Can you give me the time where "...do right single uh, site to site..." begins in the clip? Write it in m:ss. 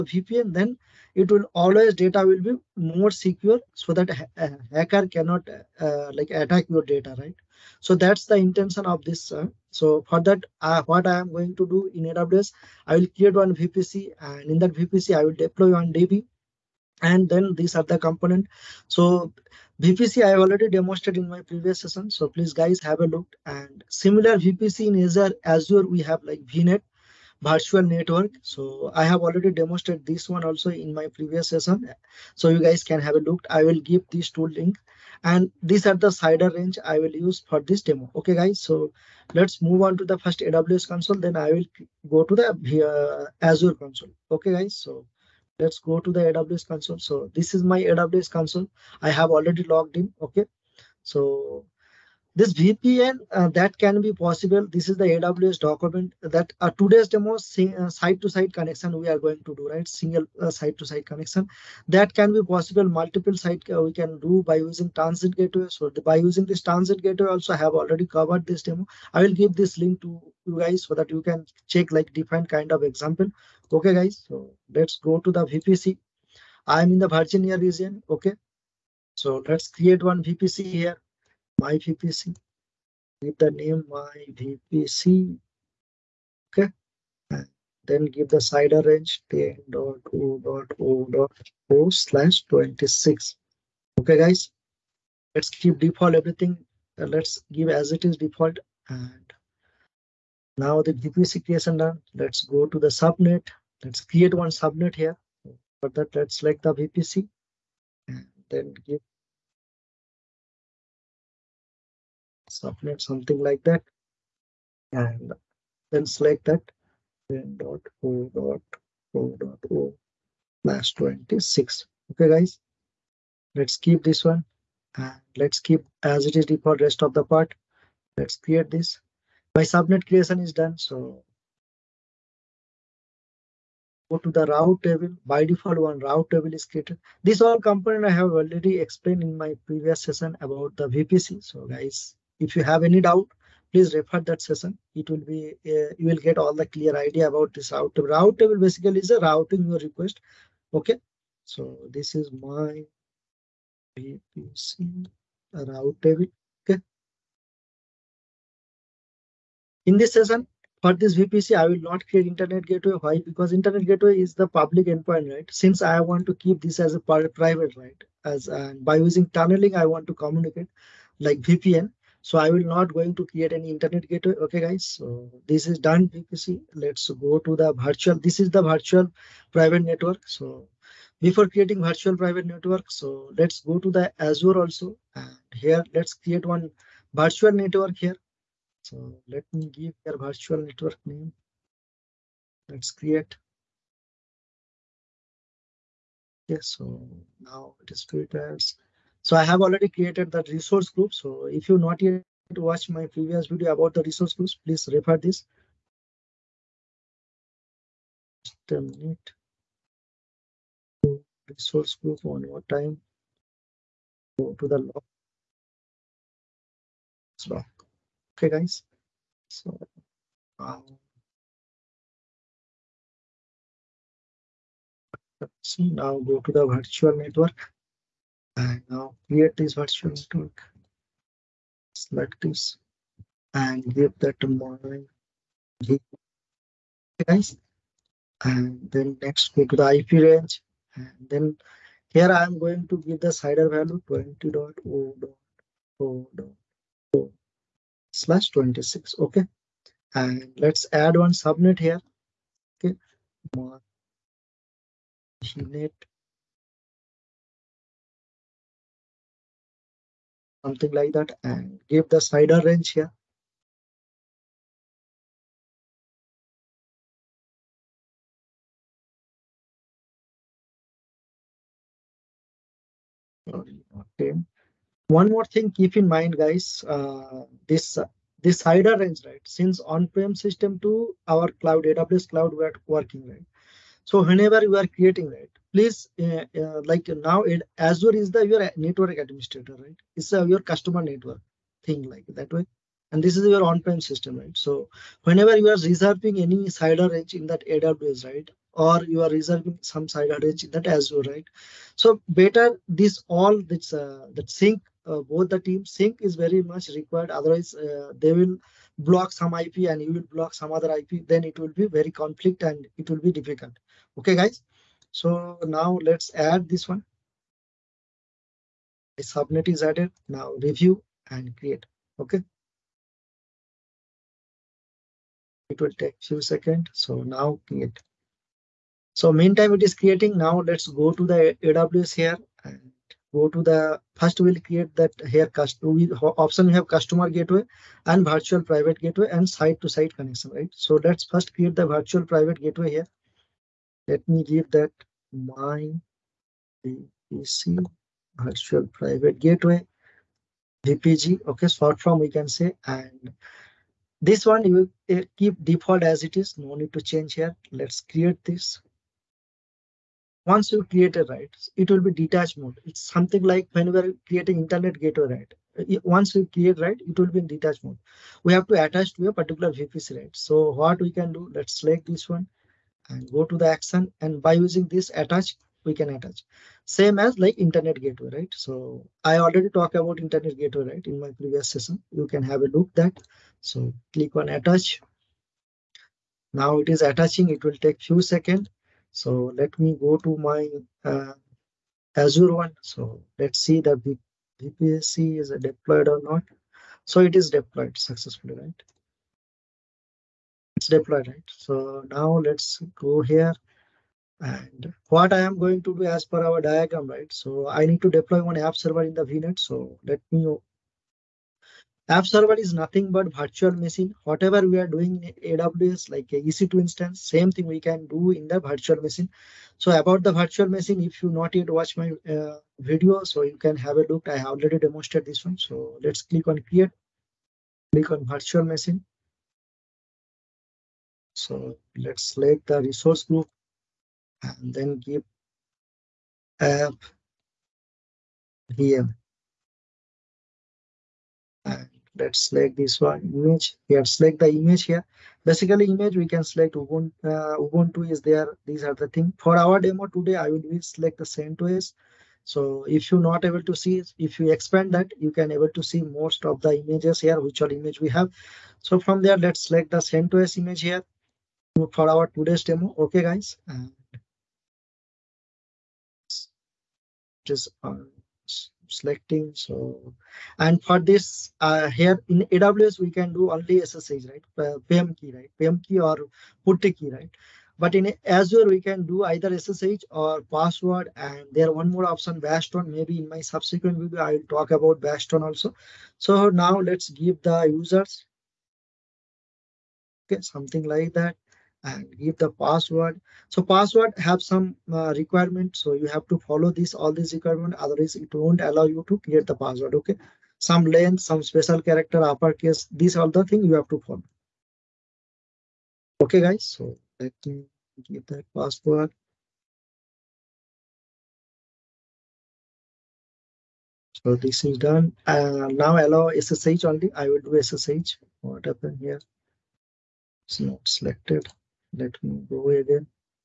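0:59.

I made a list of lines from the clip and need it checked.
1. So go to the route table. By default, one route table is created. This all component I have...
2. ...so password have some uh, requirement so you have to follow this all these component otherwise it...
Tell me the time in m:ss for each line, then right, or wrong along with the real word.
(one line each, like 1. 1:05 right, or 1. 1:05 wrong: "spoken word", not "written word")
1. 2:10 right
2. 8:13 wrong: "requirement", not "component".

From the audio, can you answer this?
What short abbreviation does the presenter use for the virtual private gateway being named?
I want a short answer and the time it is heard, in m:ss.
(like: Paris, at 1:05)
VPG, at 5:50.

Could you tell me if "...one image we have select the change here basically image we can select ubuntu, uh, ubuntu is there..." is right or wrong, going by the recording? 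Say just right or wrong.
wrong.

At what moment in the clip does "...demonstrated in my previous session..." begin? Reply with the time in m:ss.
0:20.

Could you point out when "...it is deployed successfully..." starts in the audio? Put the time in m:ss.
6:37.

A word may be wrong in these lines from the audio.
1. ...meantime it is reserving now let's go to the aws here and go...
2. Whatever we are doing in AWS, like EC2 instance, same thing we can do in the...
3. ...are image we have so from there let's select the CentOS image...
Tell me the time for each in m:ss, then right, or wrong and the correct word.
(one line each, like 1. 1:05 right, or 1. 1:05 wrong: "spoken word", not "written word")
1. 5:29 wrong: "creating", not "reserving"
2. 6:54 right
3. 7:37 right.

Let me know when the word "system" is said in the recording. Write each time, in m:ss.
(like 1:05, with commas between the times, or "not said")
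4:40, 4:54.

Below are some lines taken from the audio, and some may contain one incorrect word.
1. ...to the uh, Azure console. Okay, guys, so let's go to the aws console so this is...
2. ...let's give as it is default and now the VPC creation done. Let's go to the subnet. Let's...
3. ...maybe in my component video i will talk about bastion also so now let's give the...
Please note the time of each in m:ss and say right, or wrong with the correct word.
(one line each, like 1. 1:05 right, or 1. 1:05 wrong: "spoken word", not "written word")
1. 0:42 right
2. 1:37 right
3. 8:02 wrong: "subsequent", not "component".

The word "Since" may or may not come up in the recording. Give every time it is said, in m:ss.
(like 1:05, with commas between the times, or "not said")
2:45, 4:39.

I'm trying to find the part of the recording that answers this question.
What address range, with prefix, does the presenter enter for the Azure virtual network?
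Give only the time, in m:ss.
4:04.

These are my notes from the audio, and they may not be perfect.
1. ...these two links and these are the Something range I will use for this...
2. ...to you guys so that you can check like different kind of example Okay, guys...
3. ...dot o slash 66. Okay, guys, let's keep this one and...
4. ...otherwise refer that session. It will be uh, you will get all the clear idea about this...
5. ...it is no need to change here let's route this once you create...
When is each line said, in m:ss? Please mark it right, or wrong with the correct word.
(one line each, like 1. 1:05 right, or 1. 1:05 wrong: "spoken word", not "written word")
1. 0:34 wrong: "CIDR", not "Something"
2. 1:10 right
3. 1:59 wrong: "26", not "66"
4. 2:23 wrong: "please", not "otherwise"
5. 5:56 wrong: "create", not "route".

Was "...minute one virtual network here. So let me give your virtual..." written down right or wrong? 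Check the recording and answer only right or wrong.
wrong.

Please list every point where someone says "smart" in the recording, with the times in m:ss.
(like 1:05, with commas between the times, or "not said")
not said.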